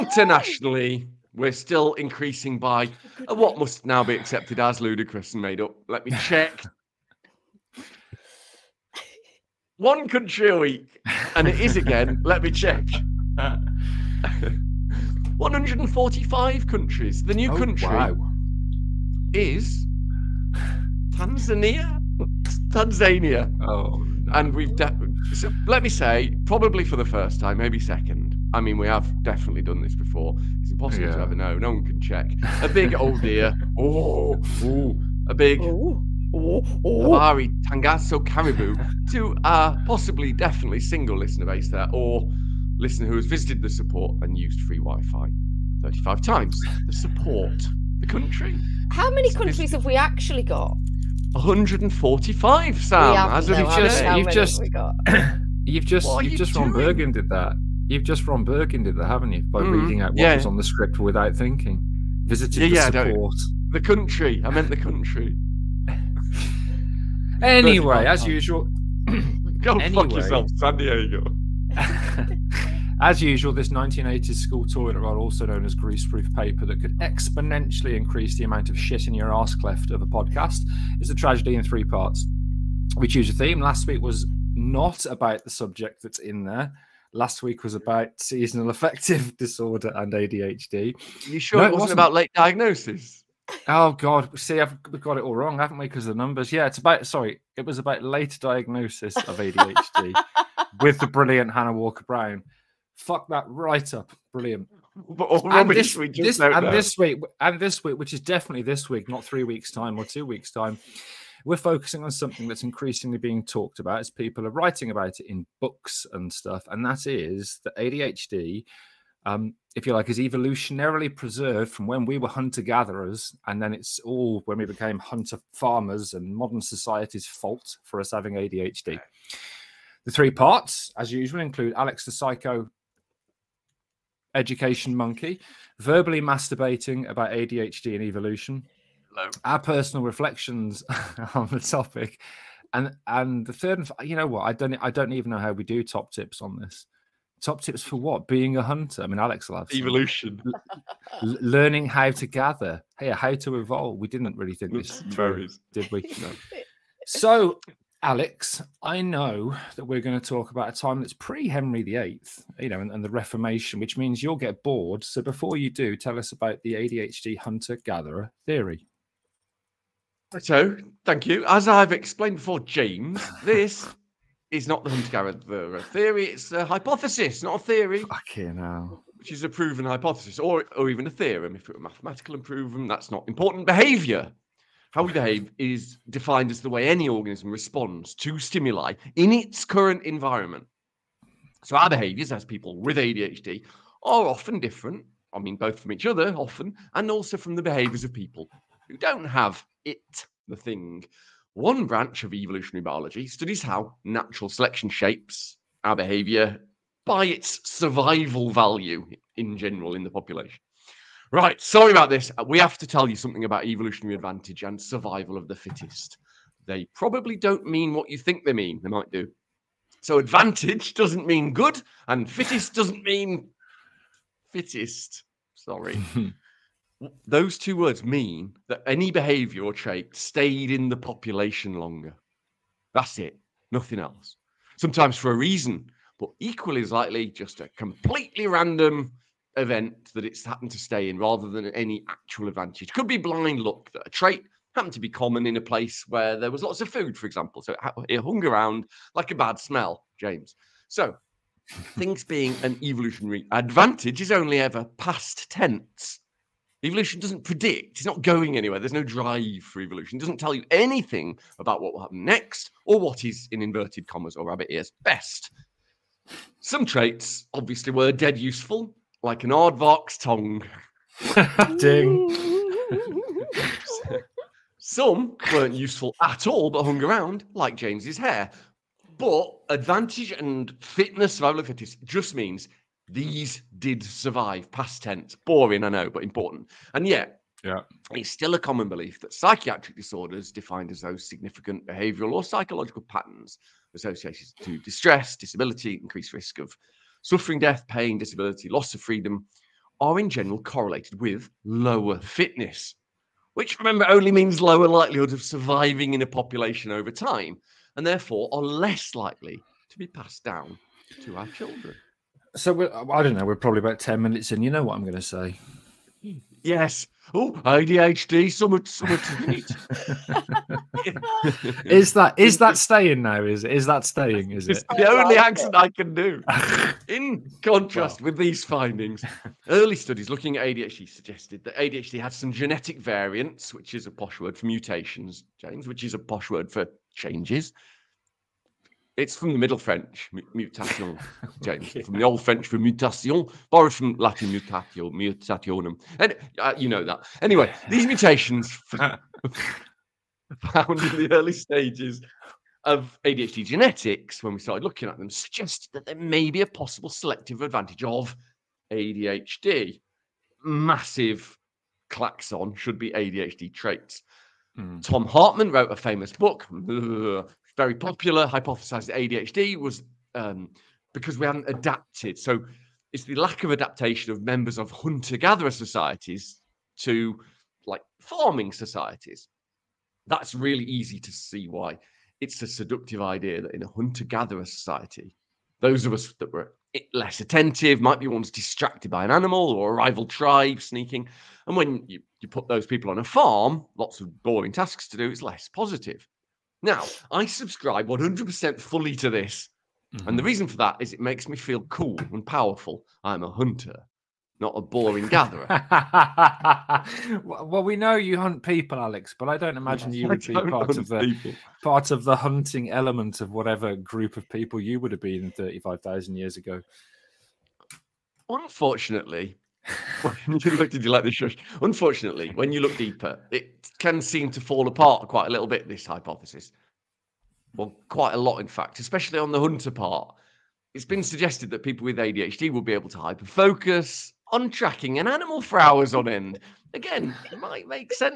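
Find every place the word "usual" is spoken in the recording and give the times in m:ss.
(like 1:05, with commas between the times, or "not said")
1:08, 1:13, 2:11.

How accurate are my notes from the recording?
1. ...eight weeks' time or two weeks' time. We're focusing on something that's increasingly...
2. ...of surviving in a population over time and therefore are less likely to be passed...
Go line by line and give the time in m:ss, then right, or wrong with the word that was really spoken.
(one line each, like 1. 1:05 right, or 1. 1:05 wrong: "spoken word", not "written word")
1. 1:49 wrong: "three", not "eight"
2. 5:05 right.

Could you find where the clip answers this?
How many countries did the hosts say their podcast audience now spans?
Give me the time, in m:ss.
0:15.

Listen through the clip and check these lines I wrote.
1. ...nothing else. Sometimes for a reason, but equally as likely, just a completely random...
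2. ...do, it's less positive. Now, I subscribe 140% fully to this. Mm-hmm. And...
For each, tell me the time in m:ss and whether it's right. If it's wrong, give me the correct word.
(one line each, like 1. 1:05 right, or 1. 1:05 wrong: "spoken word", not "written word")
1. 3:53 right
2. 6:35 wrong: "100", not "140".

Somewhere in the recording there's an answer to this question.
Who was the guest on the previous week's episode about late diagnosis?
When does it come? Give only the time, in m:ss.
1:41.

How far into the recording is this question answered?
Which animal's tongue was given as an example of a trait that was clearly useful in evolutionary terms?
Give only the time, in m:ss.
4:29.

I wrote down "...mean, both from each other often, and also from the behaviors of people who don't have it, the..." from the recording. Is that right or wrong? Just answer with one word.
right.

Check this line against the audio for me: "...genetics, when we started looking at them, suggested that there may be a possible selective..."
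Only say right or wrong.
right.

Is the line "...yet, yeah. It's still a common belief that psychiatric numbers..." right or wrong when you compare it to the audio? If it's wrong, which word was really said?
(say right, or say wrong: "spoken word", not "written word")
wrong: "disorders", not "numbers".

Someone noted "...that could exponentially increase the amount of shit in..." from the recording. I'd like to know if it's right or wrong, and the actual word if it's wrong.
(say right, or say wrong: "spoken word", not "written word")
right.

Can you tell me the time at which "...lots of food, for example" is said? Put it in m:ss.
4:06.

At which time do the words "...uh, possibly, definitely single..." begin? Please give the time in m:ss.
0:39.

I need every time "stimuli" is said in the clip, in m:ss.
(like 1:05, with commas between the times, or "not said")
3:08.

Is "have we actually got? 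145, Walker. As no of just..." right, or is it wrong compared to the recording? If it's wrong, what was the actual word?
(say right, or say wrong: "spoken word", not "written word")
wrong: "Sam", not "Walker".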